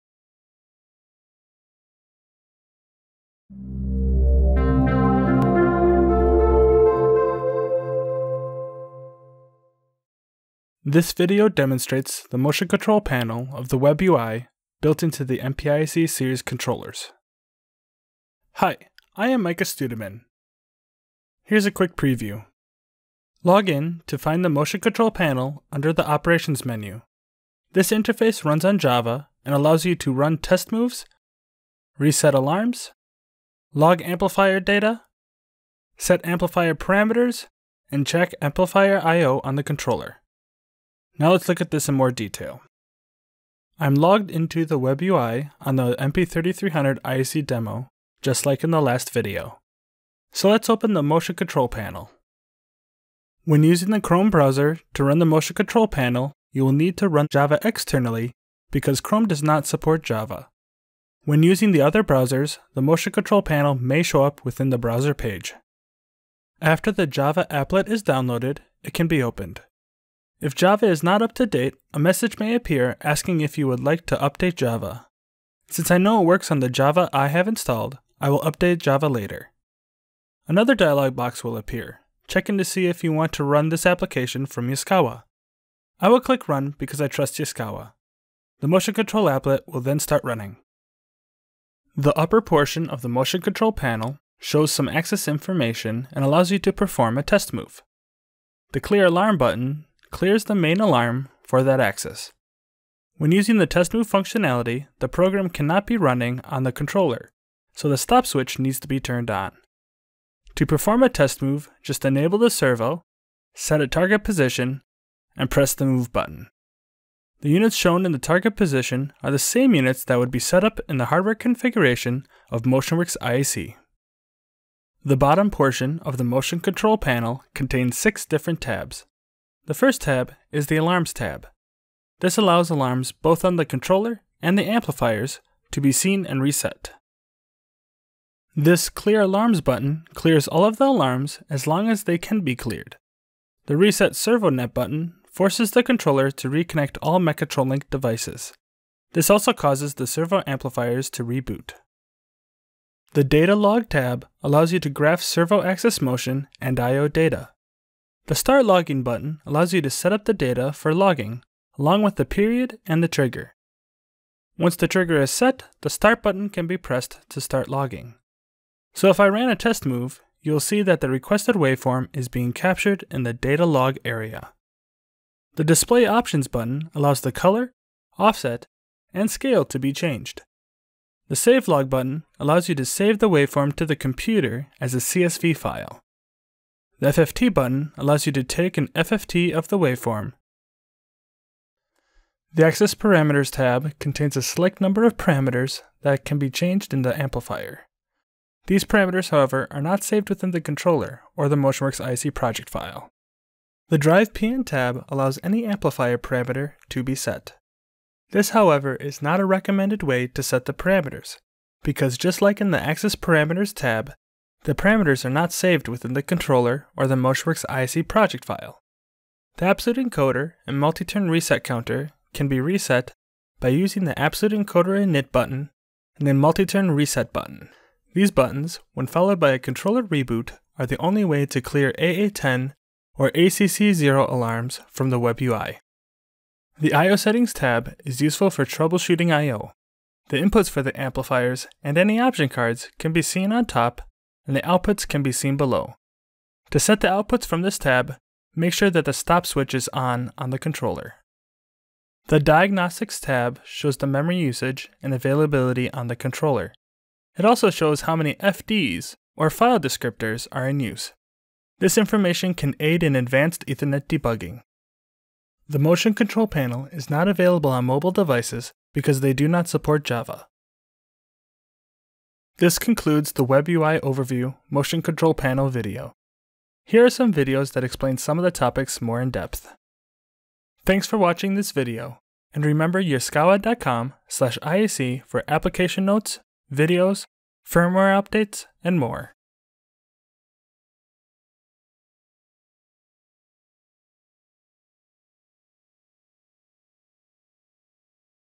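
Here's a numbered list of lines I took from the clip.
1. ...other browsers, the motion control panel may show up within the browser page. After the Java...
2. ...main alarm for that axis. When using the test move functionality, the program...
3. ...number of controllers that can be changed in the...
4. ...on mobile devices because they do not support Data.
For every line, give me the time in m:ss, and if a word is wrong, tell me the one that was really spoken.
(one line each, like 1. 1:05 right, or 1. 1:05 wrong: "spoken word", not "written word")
1. 1:01 right
2. 1:40 right
3. 3:14 wrong: "parameters", not "controllers"
4. 4:27 wrong: "Java", not "Data".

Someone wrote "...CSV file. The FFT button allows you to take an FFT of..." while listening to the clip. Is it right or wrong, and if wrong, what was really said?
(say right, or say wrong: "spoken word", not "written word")
right.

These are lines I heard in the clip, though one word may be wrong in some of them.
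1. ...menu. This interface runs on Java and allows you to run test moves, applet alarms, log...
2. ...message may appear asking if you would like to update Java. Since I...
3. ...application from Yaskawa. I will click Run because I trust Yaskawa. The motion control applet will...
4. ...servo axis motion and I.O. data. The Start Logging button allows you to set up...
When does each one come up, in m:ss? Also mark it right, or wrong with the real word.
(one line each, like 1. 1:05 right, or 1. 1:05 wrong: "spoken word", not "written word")
1. 0:26 wrong: "reset", not "applet"
2. 1:11 right
3. 1:23 right
4. 2:35 right.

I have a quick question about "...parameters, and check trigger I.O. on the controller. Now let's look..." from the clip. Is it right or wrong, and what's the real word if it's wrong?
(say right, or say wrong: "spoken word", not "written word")
wrong: "amplifier", not "trigger".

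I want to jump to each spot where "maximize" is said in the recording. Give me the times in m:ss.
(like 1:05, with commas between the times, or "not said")
not said.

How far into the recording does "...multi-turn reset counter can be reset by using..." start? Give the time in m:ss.
3:40.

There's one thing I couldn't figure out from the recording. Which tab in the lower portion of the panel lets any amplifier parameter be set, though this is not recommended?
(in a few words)
Drive PN.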